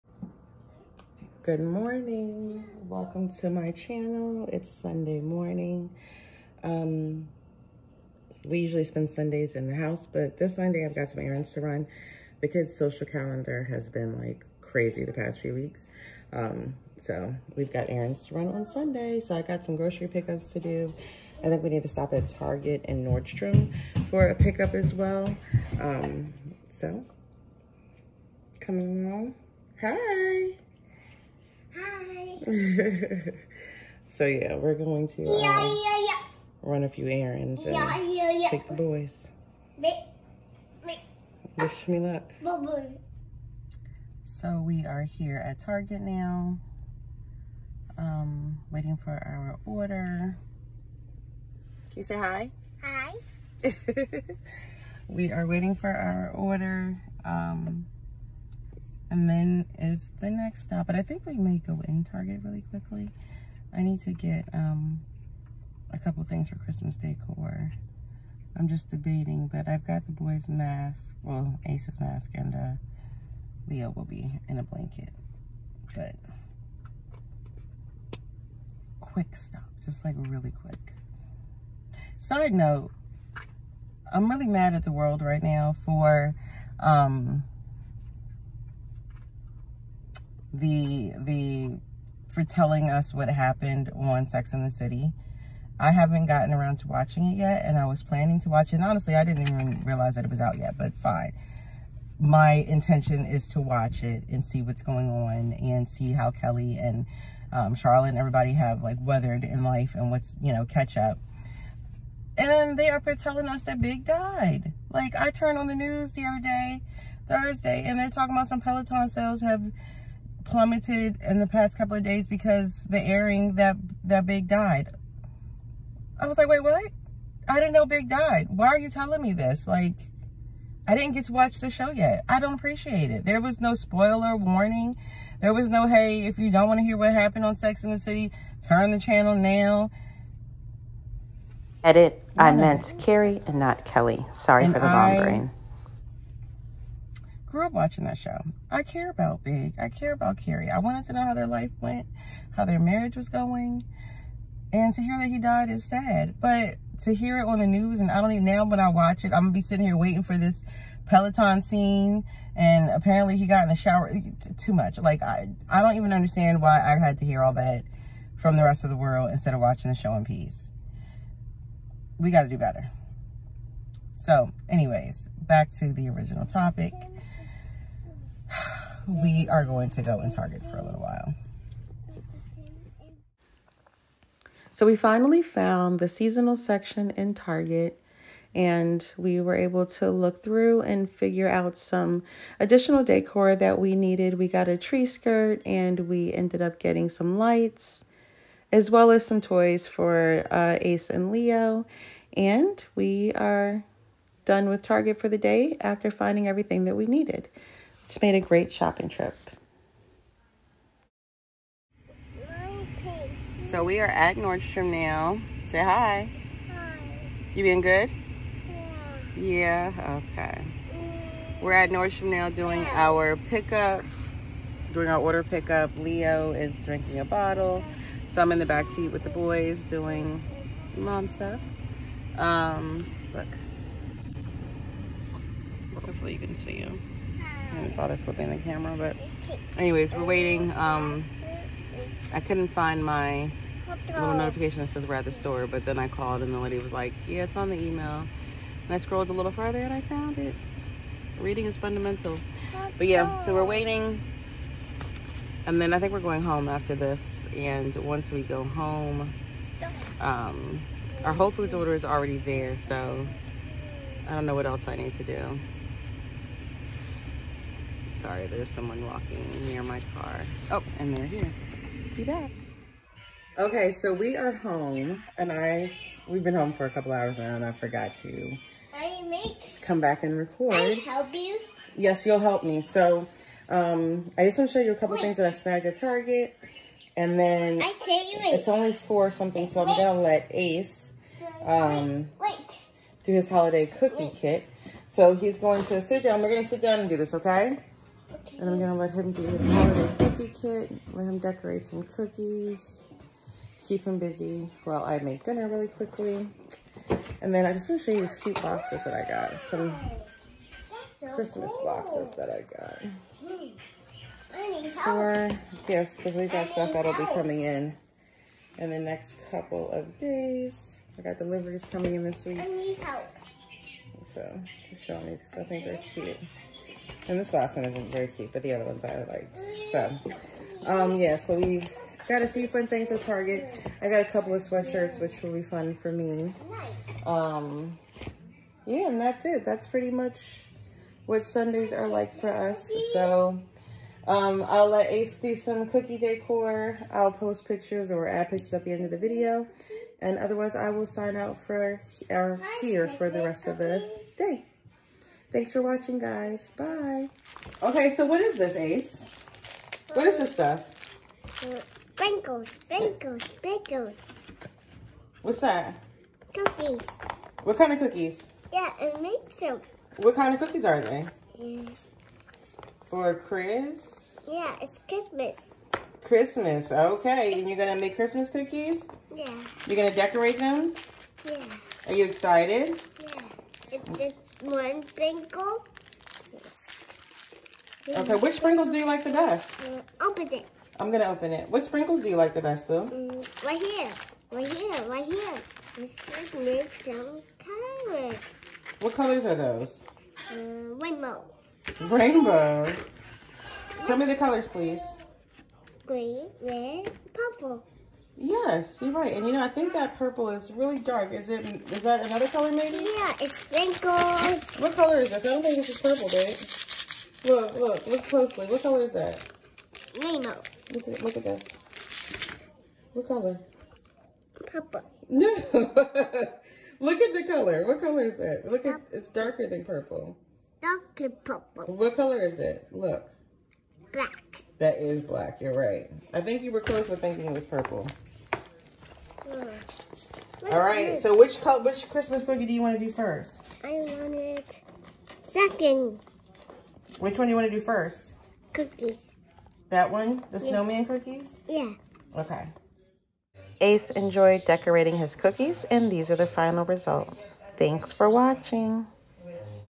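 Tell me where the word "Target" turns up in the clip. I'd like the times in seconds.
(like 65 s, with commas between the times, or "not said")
22 s, 45 s, 62 s, 180 s, 187 s, 204 s, 285 s, 333 s.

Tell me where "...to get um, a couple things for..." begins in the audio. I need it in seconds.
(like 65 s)
64 s.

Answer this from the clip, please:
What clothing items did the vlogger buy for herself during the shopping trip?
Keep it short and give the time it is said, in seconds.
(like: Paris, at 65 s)
Sweatshirts, at 334 s.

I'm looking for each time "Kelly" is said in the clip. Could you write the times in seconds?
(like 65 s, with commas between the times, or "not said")
106 s, 143 s.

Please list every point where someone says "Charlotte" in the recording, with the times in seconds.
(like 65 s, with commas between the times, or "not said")
107 s.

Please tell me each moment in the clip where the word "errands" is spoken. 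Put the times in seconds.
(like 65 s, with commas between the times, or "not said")
11 s, 17 s, 37 s.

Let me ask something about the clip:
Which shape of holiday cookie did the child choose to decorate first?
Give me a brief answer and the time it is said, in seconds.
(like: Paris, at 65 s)
Snowman, at 450 s.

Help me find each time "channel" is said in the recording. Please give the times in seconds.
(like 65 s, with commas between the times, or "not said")
3 s, 138 s.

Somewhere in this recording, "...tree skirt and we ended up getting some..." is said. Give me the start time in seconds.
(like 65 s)
194 s.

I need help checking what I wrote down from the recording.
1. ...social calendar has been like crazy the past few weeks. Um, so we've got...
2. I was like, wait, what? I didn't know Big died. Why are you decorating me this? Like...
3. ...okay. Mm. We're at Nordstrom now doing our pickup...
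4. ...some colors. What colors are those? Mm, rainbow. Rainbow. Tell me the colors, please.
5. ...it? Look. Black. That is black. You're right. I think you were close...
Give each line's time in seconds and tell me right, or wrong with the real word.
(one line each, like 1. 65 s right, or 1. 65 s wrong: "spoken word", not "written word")
1. 12 s right
2. 126 s wrong: "telling", not "decorating"
3. 220 s right
4. 396 s right
5. 432 s right.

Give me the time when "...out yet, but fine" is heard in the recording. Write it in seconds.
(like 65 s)
100 s.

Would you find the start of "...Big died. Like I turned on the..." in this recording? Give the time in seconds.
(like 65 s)
113 s.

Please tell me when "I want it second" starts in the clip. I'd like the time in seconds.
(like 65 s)
443 s.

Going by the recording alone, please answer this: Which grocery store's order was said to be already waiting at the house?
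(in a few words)
Whole Foods.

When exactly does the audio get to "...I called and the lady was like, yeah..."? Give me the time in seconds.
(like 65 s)
245 s.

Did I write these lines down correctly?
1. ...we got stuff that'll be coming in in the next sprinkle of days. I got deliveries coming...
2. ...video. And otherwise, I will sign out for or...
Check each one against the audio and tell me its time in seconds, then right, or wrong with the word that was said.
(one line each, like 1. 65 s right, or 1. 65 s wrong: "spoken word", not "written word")
1. 316 s wrong: "couple", not "sprinkle"
2. 349 s right.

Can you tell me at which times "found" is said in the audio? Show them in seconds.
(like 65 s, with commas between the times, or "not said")
185 s, 250 s.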